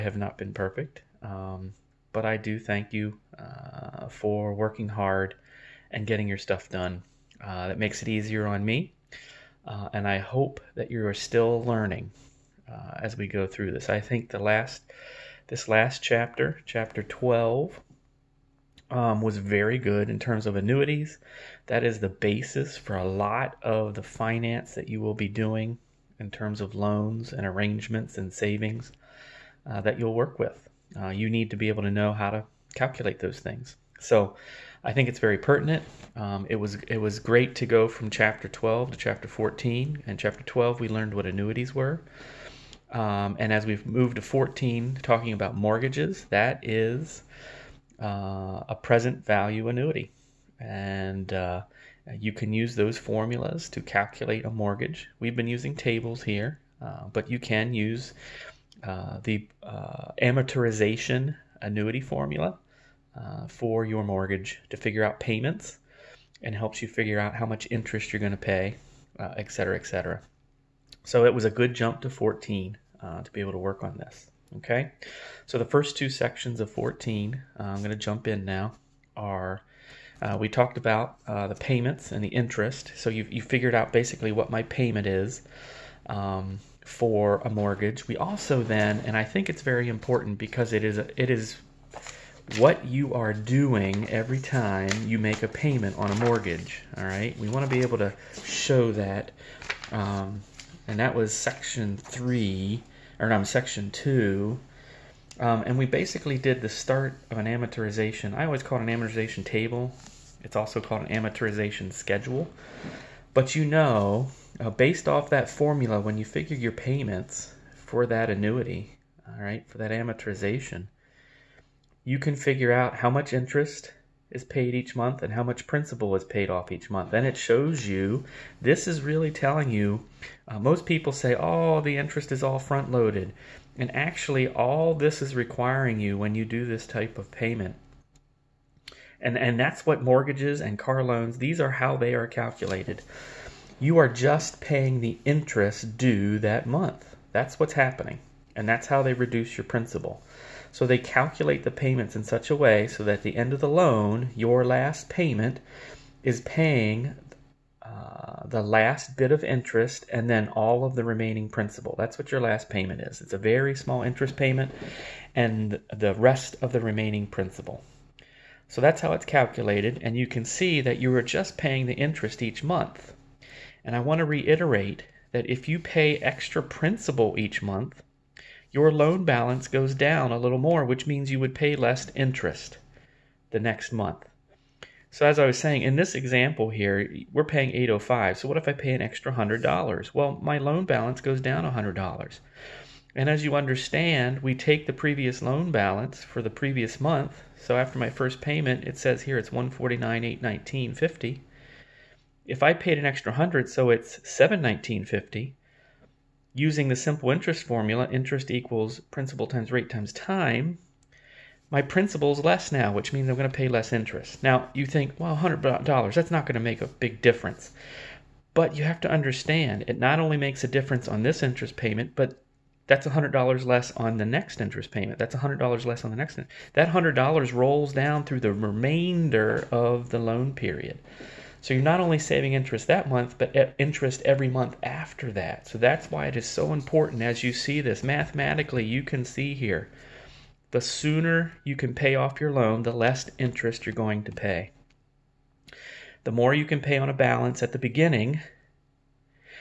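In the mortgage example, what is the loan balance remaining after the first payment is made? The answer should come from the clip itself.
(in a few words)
$149,819.50.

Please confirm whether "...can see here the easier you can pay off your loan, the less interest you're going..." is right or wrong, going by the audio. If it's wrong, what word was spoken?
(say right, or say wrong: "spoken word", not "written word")
wrong: "sooner", not "easier".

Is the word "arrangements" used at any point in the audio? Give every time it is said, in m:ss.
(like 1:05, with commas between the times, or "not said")
0:27.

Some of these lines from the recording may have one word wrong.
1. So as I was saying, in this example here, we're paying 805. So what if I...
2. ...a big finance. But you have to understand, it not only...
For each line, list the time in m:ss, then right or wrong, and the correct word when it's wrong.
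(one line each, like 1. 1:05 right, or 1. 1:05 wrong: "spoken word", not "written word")
1. 3:05 right
2. 3:36 wrong: "difference", not "finance".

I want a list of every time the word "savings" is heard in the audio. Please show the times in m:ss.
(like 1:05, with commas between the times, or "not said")
0:28, 3:52.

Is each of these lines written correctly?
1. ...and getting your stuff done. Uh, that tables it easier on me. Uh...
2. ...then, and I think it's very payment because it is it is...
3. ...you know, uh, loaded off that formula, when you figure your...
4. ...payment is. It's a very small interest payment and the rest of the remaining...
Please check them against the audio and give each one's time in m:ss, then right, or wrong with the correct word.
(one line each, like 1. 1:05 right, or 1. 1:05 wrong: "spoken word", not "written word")
1. 0:05 wrong: "makes", not "tables"
2. 1:28 wrong: "important", not "payment"
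3. 1:53 wrong: "based", not "loaded"
4. 2:42 right.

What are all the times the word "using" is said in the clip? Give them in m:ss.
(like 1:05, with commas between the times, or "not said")
0:55, 3:26.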